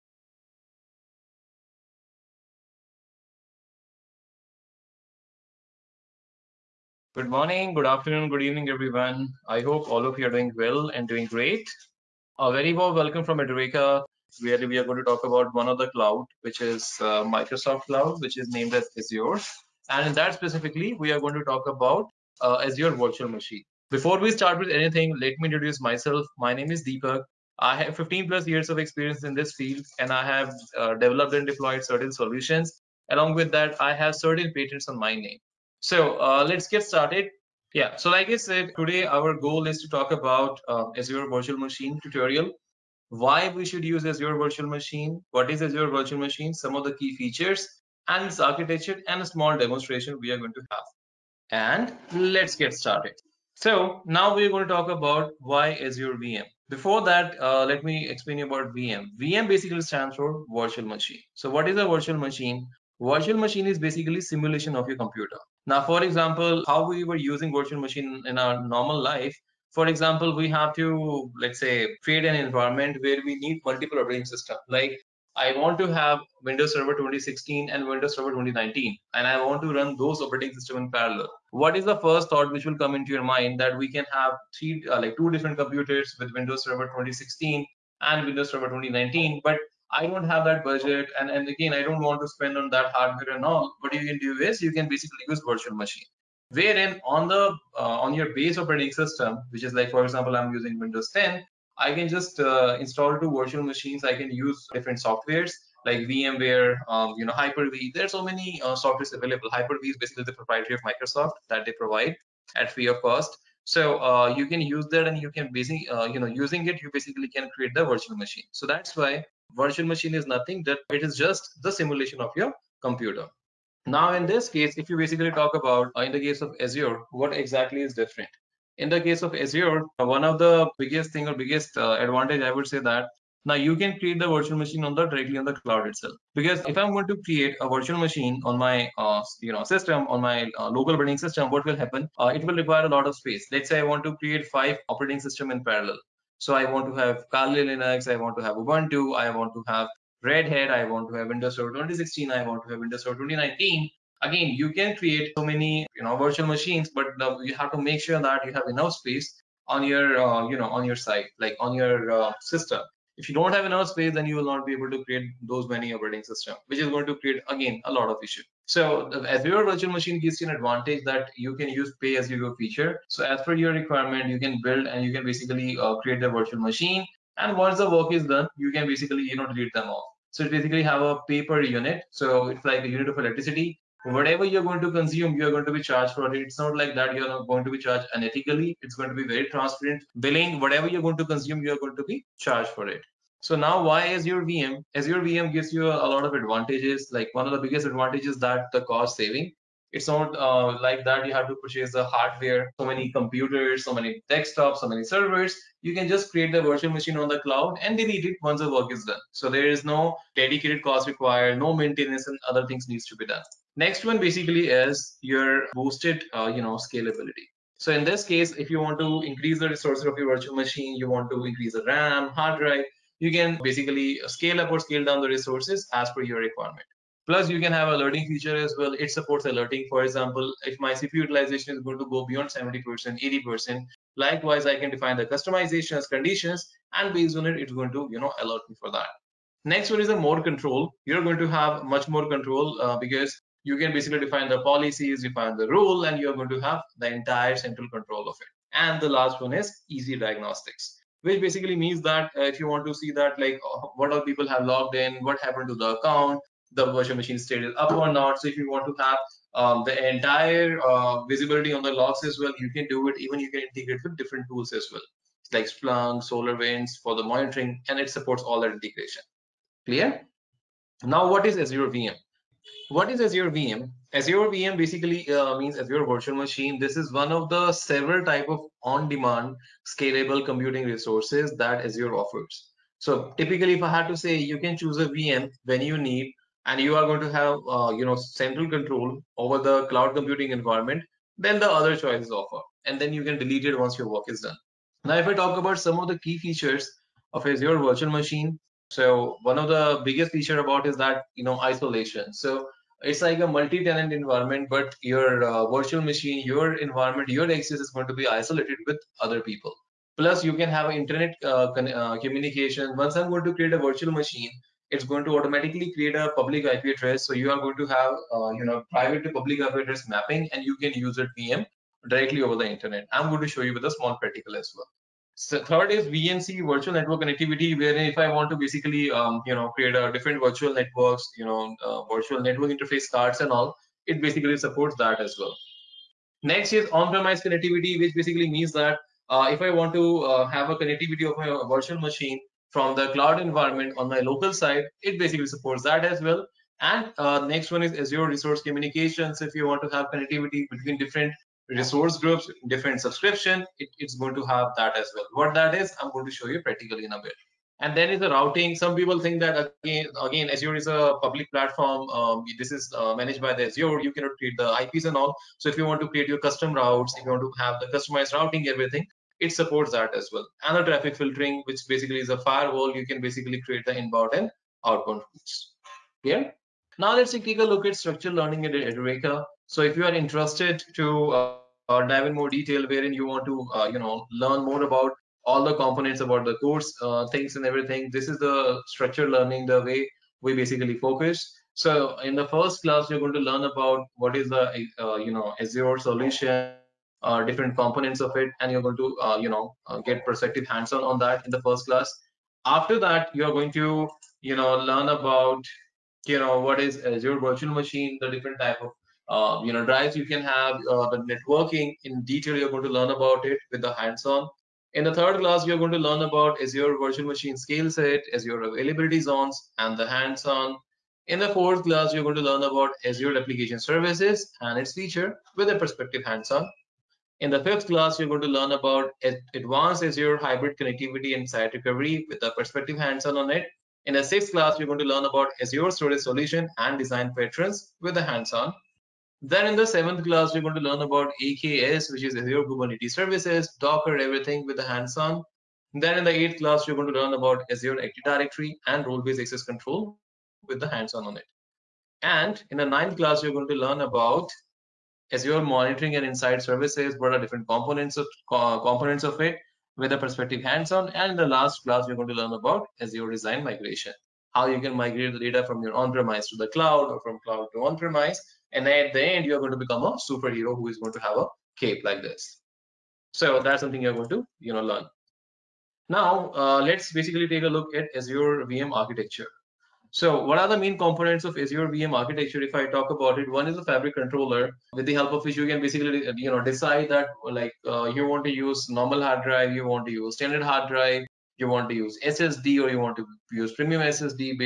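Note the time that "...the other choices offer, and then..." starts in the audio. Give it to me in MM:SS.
04:51.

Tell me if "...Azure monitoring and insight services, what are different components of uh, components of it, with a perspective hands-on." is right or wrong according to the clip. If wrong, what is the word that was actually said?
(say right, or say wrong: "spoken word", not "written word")
right.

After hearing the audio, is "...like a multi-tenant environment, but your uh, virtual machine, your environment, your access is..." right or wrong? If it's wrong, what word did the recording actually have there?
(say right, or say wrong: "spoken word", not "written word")
right.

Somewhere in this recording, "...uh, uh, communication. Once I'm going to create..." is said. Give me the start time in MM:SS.
05:11.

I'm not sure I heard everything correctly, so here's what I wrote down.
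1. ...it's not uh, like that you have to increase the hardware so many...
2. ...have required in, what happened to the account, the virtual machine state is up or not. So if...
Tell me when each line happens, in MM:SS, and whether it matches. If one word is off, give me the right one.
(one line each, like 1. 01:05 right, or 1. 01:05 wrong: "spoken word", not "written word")
1. 03:19 wrong: "purchase", not "increase"
2. 04:14 wrong: "logged", not "required".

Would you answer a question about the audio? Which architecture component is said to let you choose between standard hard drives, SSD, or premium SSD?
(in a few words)
Fabric controller.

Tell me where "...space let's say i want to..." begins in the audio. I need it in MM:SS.
02:23.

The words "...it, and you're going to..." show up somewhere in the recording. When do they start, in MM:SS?
06:38.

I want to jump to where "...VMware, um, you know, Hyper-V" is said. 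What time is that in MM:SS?
01:46.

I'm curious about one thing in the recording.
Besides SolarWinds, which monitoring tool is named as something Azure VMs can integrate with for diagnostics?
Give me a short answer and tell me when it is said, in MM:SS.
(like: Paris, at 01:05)
Splunk, at 04:25.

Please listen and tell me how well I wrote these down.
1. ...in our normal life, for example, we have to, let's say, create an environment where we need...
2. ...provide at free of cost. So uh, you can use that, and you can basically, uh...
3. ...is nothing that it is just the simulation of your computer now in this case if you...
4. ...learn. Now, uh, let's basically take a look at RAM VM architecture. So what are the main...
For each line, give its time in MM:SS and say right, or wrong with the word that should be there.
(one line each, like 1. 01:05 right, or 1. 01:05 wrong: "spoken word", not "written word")
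1. 01:08 right
2. 01:51 right
3. 02:00 right
4. 07:54 wrong: "Azure", not "RAM".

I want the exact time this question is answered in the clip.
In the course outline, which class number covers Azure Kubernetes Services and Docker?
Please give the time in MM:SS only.
07:19.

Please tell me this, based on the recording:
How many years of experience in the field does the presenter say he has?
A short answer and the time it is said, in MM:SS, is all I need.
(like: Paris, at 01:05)
15+, at 00:27.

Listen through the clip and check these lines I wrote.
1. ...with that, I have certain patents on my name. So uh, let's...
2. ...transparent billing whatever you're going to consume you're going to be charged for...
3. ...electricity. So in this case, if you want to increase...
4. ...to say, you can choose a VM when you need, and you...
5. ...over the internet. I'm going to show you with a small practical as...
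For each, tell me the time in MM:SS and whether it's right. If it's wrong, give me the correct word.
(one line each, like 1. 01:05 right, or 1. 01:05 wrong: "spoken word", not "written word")
1. 00:33 right
2. 03:09 right
3. 03:36 wrong: "scalability", not "electricity"
4. 04:44 right
5. 05:22 right.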